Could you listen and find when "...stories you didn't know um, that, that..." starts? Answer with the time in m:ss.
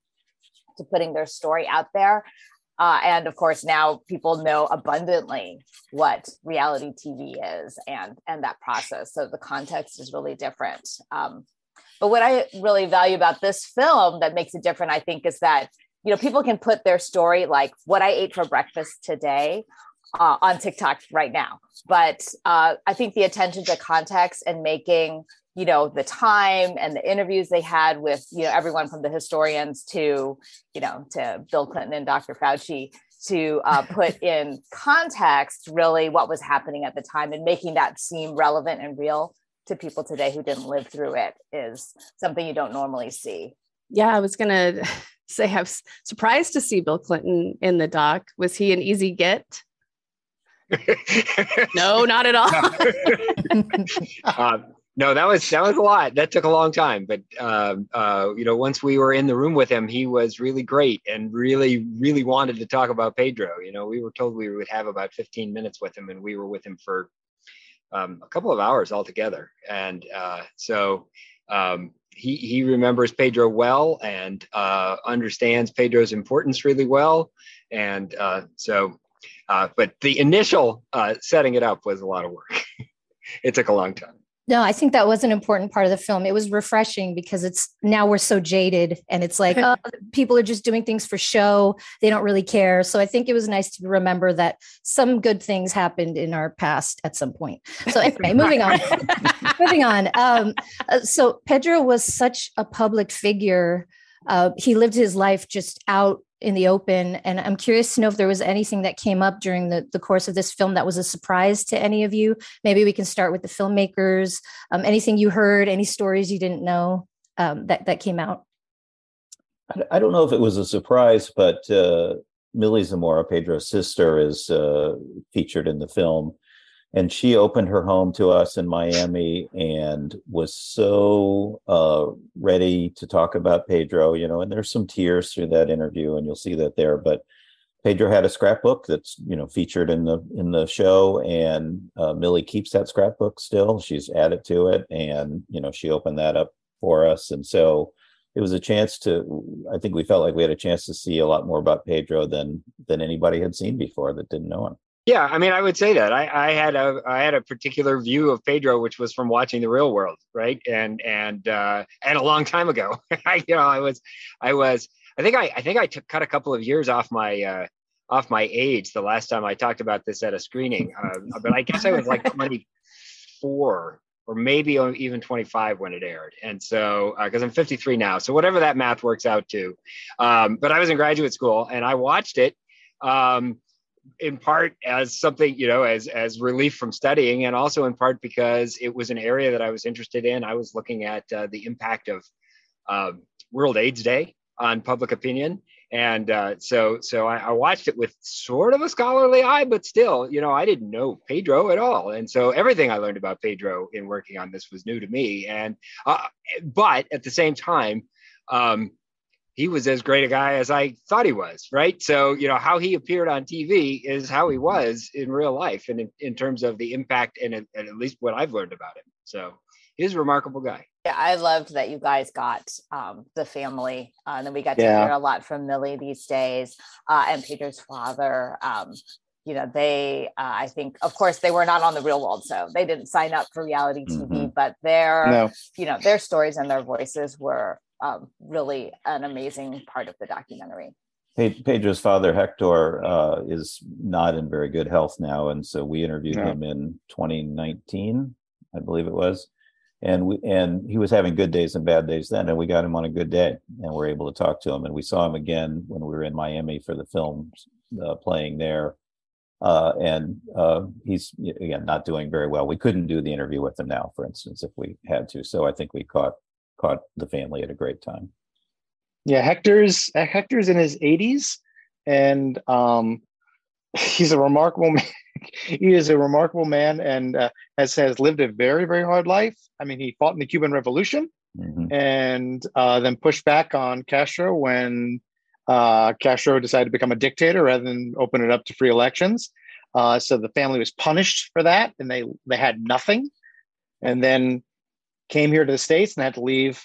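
1:55.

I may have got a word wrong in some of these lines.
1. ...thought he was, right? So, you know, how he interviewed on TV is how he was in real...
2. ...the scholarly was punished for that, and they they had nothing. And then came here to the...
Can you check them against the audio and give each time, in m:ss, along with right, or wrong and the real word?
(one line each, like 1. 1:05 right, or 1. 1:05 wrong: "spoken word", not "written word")
1. 3:31 wrong: "appeared", not "interviewed"
2. 4:50 wrong: "family", not "scholarly".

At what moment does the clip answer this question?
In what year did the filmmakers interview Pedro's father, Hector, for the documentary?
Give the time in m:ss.
4:07.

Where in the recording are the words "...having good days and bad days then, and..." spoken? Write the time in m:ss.
4:11.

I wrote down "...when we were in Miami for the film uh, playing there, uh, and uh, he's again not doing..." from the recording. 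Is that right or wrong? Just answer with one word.
right.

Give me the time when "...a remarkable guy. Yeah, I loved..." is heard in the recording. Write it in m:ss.
3:40.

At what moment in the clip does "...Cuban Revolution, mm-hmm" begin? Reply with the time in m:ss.
4:40.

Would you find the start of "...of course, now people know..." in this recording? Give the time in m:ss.
0:03.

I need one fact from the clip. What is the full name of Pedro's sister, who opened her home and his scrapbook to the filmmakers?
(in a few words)
Millie Zamora.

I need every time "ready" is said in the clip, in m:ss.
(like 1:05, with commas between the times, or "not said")
2:12.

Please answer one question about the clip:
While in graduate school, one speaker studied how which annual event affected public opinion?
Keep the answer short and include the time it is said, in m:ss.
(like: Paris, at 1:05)
World AIDS Day, at 3:13.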